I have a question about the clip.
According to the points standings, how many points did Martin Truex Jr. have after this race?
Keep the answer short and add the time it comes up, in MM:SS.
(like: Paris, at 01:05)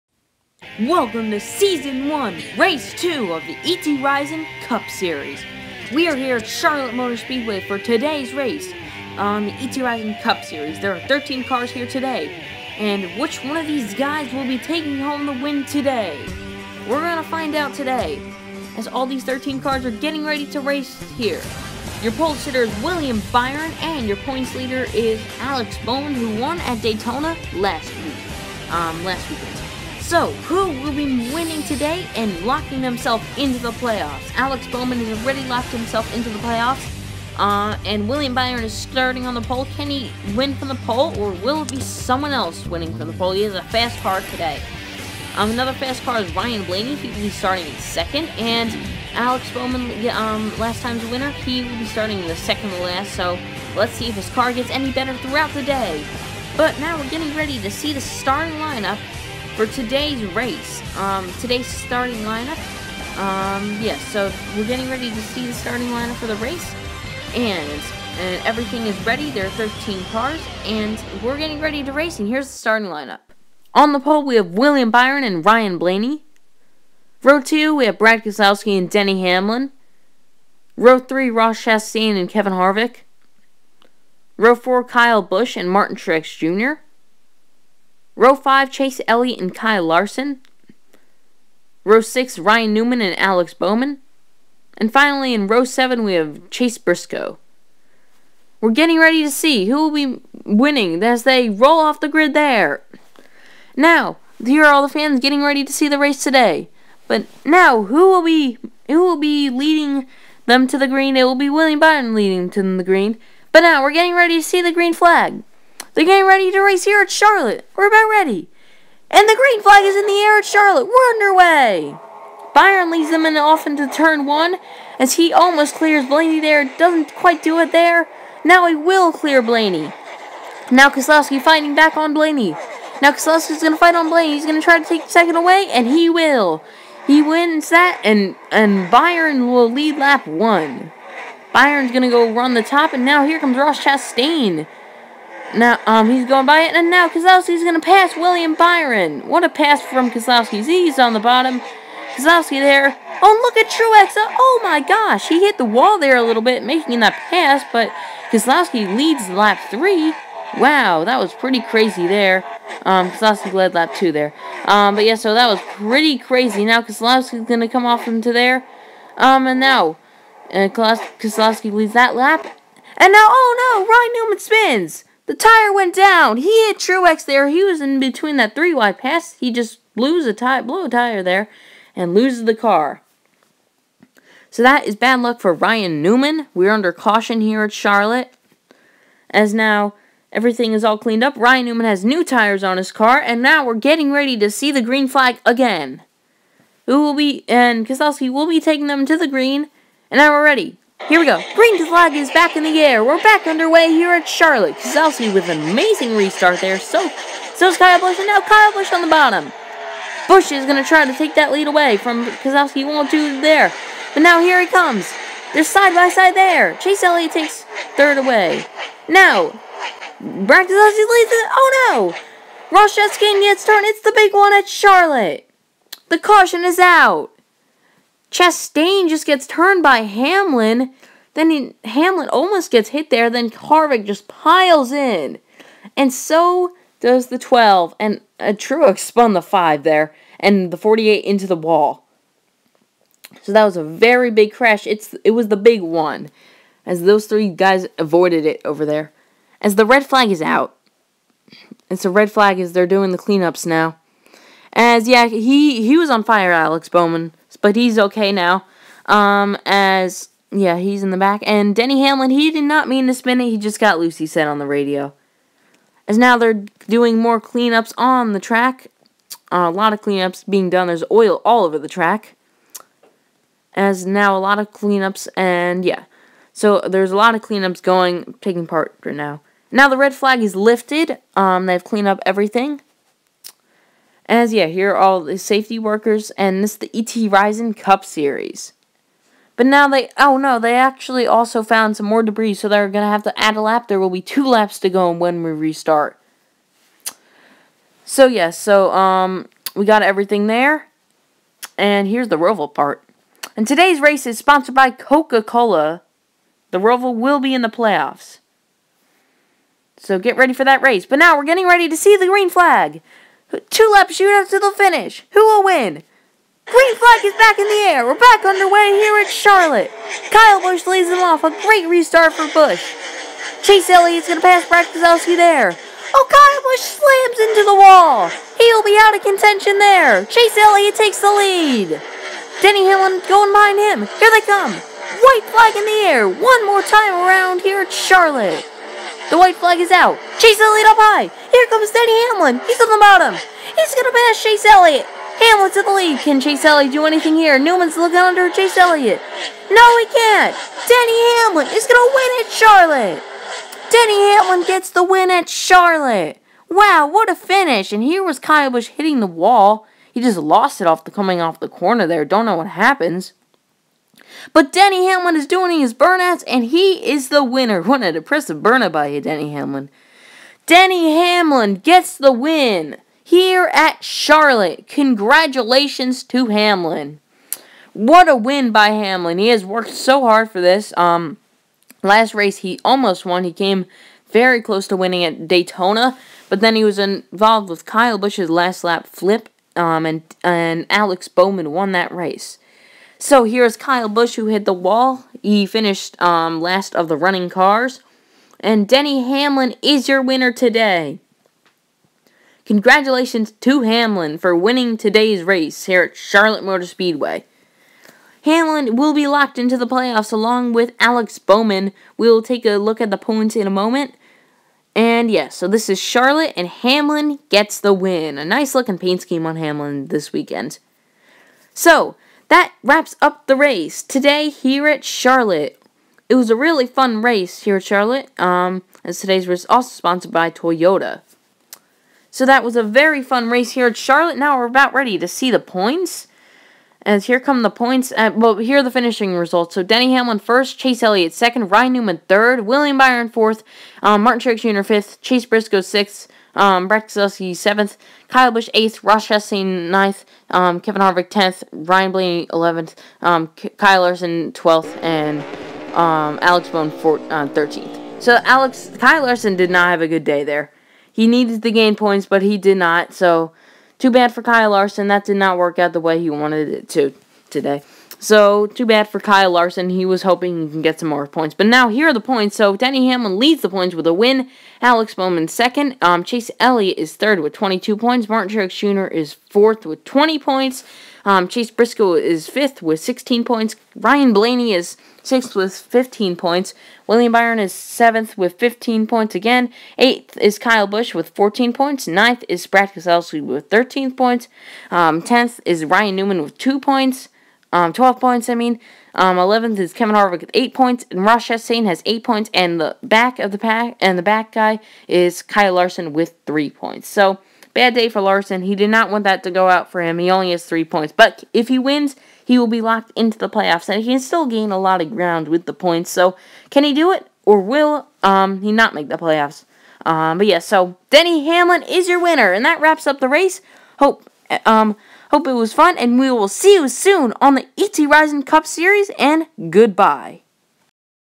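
20, at 07:59.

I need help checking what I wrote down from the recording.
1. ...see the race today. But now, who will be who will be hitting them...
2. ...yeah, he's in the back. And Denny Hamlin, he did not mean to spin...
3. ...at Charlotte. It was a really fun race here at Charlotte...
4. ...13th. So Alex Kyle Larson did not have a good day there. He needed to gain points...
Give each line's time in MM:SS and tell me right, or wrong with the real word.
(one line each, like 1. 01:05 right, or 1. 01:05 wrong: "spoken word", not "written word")
1. 01:45 wrong: "leading", not "hitting"
2. 04:20 right
3. 07:04 right
4. 07:37 right.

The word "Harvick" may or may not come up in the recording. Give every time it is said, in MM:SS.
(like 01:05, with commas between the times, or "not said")
01:22, 03:53, 07:31, 08:20.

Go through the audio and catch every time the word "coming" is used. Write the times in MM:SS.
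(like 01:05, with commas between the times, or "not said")
06:01.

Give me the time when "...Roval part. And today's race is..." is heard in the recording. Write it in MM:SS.
05:02.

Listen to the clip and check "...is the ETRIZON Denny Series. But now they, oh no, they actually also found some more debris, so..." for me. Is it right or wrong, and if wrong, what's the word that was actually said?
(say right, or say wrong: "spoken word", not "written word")
wrong: "Cup", not "Denny".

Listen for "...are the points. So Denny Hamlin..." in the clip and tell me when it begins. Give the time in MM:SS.
07:52.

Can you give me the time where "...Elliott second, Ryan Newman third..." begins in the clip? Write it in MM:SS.
07:21.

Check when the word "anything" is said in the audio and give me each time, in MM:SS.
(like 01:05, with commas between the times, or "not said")
05:47.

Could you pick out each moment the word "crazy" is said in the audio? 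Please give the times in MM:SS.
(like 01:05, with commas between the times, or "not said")
02:41, 02:46.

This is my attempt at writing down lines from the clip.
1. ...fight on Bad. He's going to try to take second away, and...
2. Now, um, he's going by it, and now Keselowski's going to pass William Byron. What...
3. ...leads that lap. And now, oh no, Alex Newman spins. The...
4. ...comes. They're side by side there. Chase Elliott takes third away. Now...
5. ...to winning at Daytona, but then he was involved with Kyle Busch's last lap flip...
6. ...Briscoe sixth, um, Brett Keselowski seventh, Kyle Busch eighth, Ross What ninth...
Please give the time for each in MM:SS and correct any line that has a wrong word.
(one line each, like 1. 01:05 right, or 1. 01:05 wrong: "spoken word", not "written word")
1. 02:13 wrong: "Blaney", not "Bad"
2. 02:25 right
3. 02:51 wrong: "Ryan", not "Alex"
4. 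03:34 right
5. 06:24 right
6. 07:25 wrong: "Chastain", not "What".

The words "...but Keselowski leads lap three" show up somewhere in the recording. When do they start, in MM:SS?
02:37.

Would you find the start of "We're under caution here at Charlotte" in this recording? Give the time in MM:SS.
03:06.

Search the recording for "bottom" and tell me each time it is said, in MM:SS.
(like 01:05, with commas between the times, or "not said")
02:31, 03:29, 05:42.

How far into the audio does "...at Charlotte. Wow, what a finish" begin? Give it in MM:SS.
05:55.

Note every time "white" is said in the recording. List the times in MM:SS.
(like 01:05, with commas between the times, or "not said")
05:34, 05:39.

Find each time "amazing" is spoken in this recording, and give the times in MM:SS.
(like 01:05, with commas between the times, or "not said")
03:25.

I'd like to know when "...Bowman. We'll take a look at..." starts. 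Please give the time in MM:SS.
06:51.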